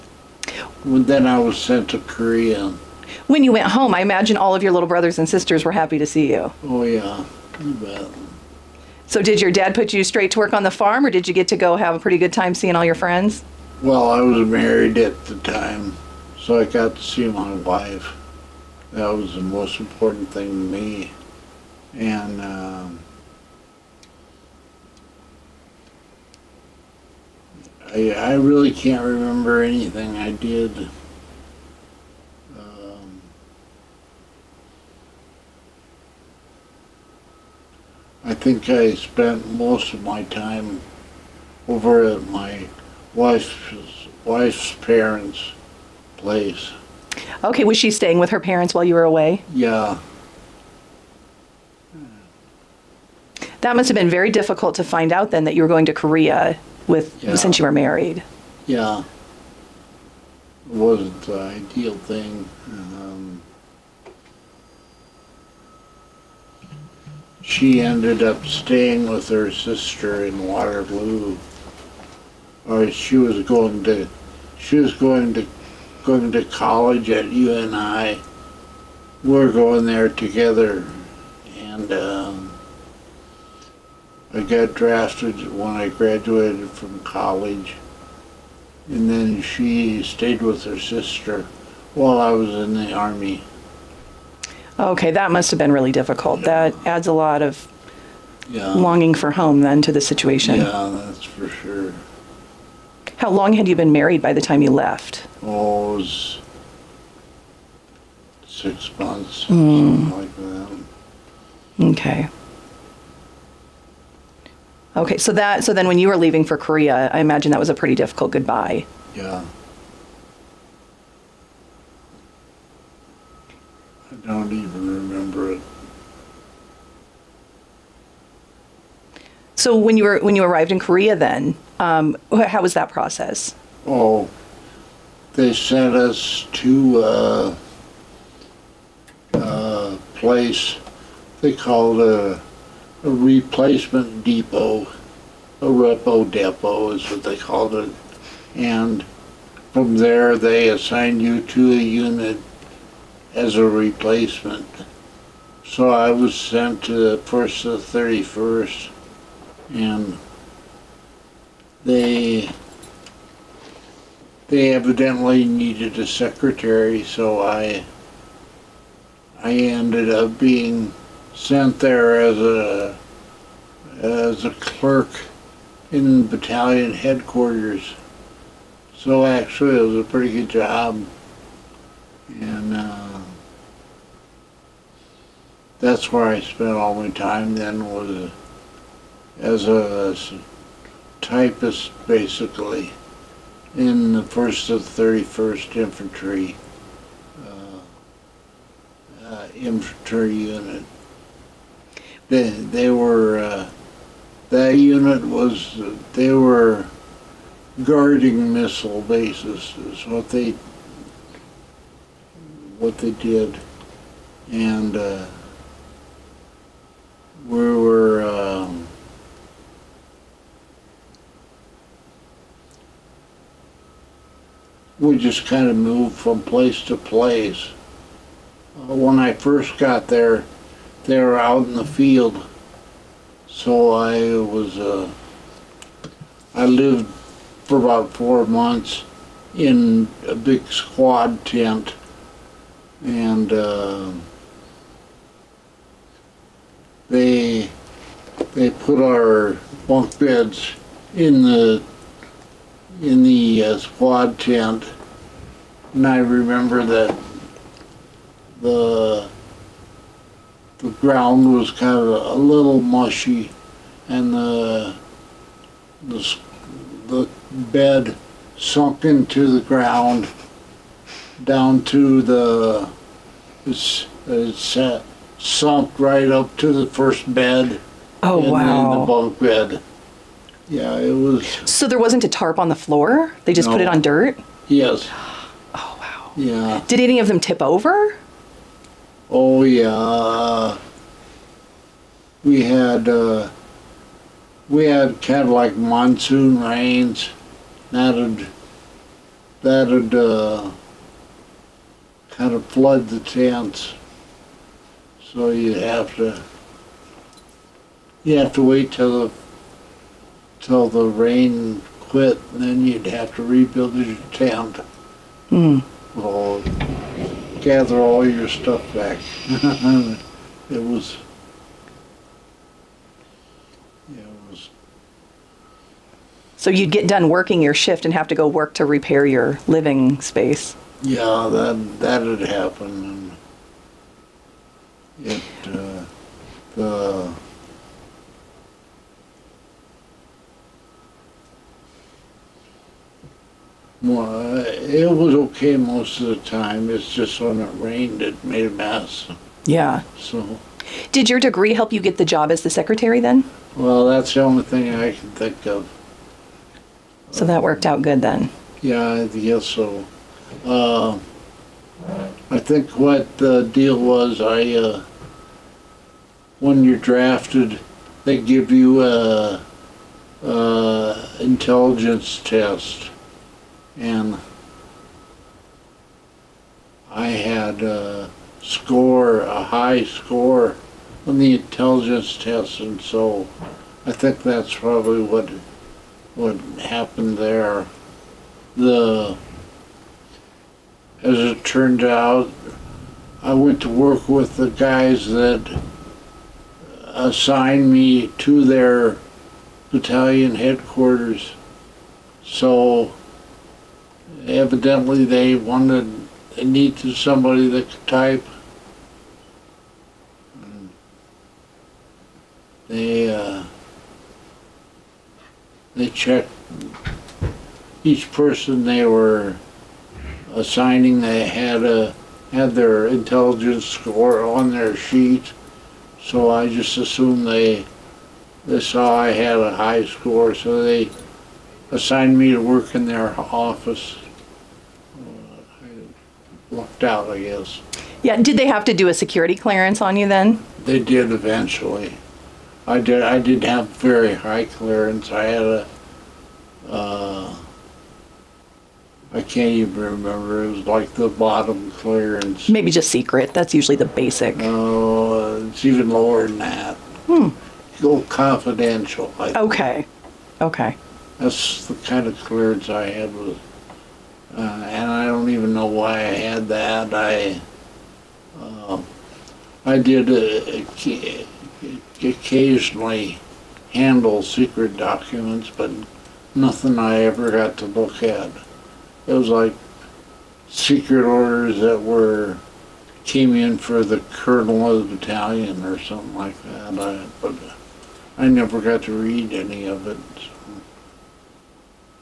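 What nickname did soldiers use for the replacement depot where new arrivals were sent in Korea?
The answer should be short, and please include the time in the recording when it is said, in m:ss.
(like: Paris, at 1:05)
repo depot, at 2:25.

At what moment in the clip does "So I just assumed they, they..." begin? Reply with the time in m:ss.
7:06.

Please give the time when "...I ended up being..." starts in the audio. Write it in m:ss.
2:49.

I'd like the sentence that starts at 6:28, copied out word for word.
The as it turned out, I went to work with the guys that assigned me to their battalion headquarters.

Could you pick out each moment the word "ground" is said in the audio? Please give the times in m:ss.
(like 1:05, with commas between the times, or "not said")
4:20, 4:29.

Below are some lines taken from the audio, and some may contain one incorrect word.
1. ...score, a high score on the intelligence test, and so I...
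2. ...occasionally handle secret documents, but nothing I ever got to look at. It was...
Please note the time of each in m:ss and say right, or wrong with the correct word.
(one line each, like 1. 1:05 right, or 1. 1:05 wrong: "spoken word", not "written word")
1. 6:18 right
2. 7:52 right.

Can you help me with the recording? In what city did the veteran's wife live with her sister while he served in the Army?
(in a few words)
Waterloo.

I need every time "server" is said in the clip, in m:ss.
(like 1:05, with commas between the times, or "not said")
not said.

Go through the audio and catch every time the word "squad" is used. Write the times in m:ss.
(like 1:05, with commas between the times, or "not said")
4:00, 4:13.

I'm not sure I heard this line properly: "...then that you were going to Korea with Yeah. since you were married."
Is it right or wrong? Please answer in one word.
right.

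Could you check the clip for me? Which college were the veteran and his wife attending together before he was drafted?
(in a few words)
UNI.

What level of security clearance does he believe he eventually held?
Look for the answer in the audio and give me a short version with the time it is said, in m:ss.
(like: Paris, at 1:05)
confidential, at 7:38.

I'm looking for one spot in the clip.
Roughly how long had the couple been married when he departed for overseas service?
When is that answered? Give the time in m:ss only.
1:48.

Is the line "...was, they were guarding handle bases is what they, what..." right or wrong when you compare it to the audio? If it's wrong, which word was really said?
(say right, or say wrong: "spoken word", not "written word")
wrong: "missile", not "handle".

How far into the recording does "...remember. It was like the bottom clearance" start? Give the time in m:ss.
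7:30.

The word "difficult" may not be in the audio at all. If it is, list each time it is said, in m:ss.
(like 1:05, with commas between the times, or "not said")
0:54, 1:35, 1:57.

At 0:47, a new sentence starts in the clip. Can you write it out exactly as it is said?
Okay, was she staying with her parents while you were away?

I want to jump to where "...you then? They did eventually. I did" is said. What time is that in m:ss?
7:20.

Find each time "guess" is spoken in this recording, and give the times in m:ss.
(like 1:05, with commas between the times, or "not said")
5:59, 7:17.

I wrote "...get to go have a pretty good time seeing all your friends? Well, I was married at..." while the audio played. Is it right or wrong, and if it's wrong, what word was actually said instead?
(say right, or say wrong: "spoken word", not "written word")
right.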